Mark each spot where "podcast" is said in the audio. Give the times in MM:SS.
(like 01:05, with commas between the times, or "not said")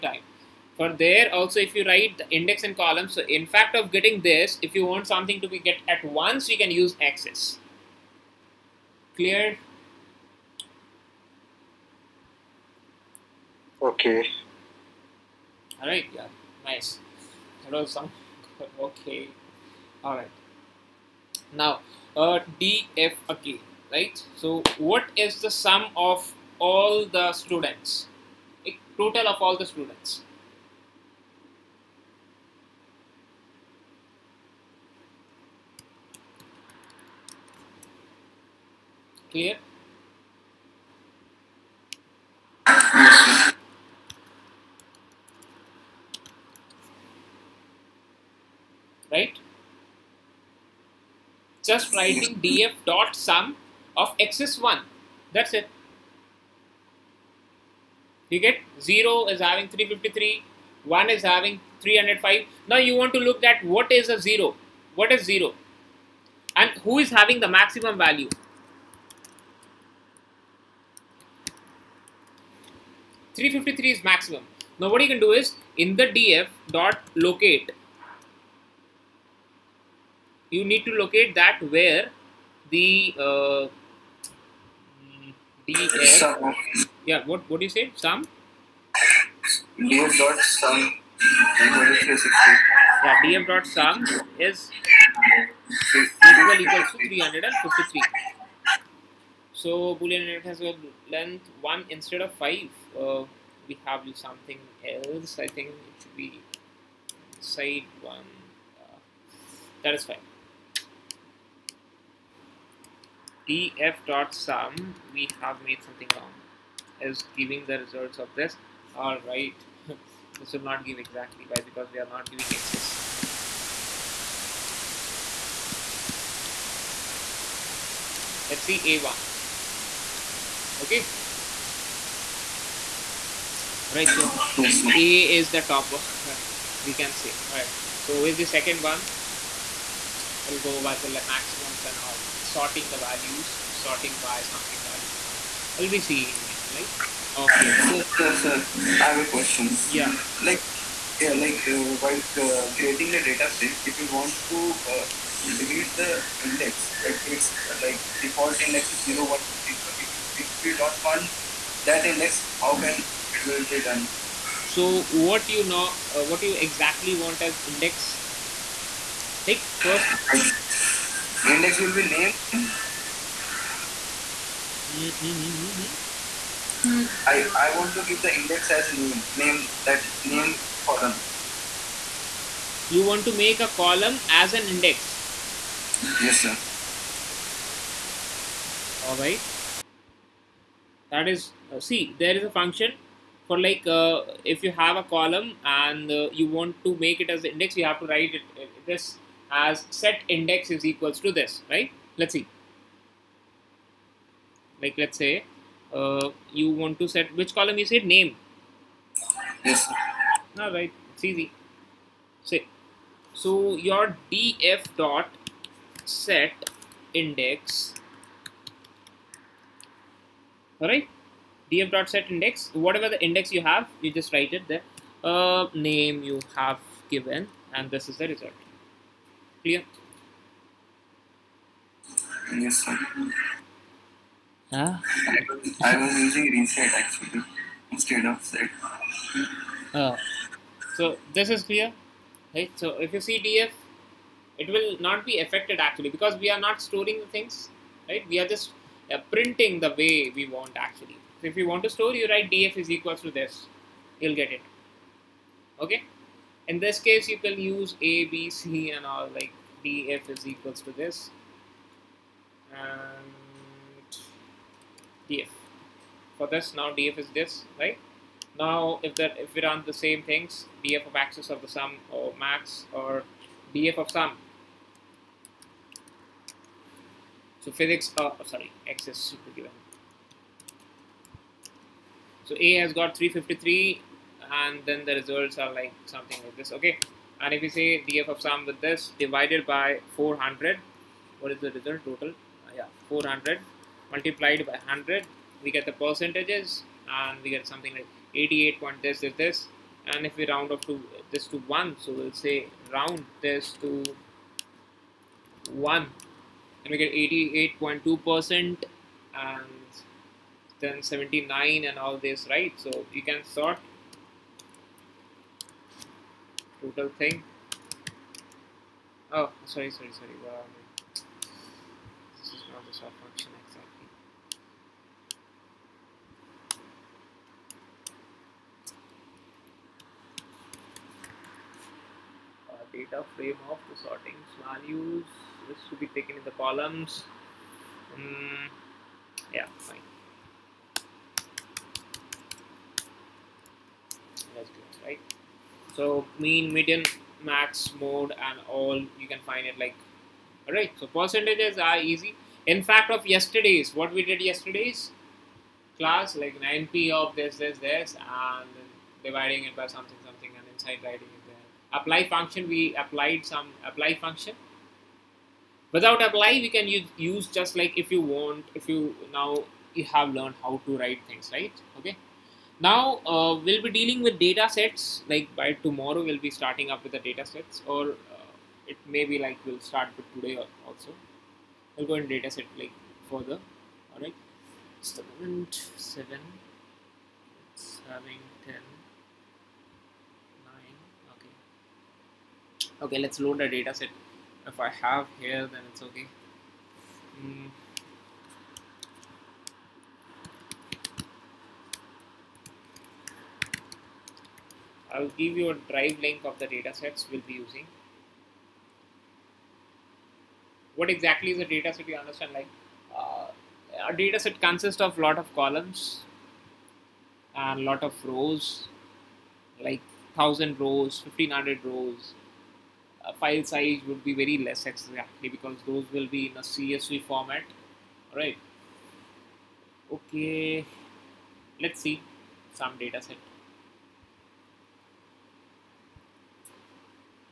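not said.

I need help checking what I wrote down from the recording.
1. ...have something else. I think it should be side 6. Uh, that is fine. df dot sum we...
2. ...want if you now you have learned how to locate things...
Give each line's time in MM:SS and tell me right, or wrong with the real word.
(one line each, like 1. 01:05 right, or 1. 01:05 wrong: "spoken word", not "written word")
1. 01:43 wrong: "1", not "6"
2. 06:08 wrong: "write", not "locate".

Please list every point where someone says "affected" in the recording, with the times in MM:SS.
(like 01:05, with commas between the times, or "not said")
04:05.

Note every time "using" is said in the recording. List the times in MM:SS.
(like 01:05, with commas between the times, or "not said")
03:56, 06:47.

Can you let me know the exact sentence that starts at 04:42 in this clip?
So A has got 353 and then the results are like something like this, okay?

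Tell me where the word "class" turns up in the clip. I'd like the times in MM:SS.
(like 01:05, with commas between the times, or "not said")
05:55.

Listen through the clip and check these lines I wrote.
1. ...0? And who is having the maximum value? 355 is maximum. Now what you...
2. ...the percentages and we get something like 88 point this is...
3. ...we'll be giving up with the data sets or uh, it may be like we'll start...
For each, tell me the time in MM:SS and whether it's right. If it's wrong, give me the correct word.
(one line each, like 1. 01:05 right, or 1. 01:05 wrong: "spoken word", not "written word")
1. 01:05 wrong: "353", not "355"
2. 04:55 right
3. 06:16 wrong: "starting", not "giving".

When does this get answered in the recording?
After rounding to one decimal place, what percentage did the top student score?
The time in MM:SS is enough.
05:07.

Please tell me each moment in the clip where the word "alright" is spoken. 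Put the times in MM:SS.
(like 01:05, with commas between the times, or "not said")
00:15, 00:20, 03:40.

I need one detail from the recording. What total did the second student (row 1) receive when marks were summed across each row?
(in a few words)
305.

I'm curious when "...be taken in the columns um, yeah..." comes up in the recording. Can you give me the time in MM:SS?
05:35.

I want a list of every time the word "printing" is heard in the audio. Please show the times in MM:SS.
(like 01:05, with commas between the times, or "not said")
04:09.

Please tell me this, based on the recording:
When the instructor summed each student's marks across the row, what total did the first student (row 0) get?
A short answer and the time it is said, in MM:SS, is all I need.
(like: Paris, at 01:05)
353, at 00:58.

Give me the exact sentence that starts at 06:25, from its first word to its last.
seven it's having 10 9 okay okay let's load the data set if I have hair then it's okay mm.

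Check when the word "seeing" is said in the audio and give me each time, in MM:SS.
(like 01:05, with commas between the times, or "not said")
02:26.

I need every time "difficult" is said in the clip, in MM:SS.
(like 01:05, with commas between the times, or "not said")
not said.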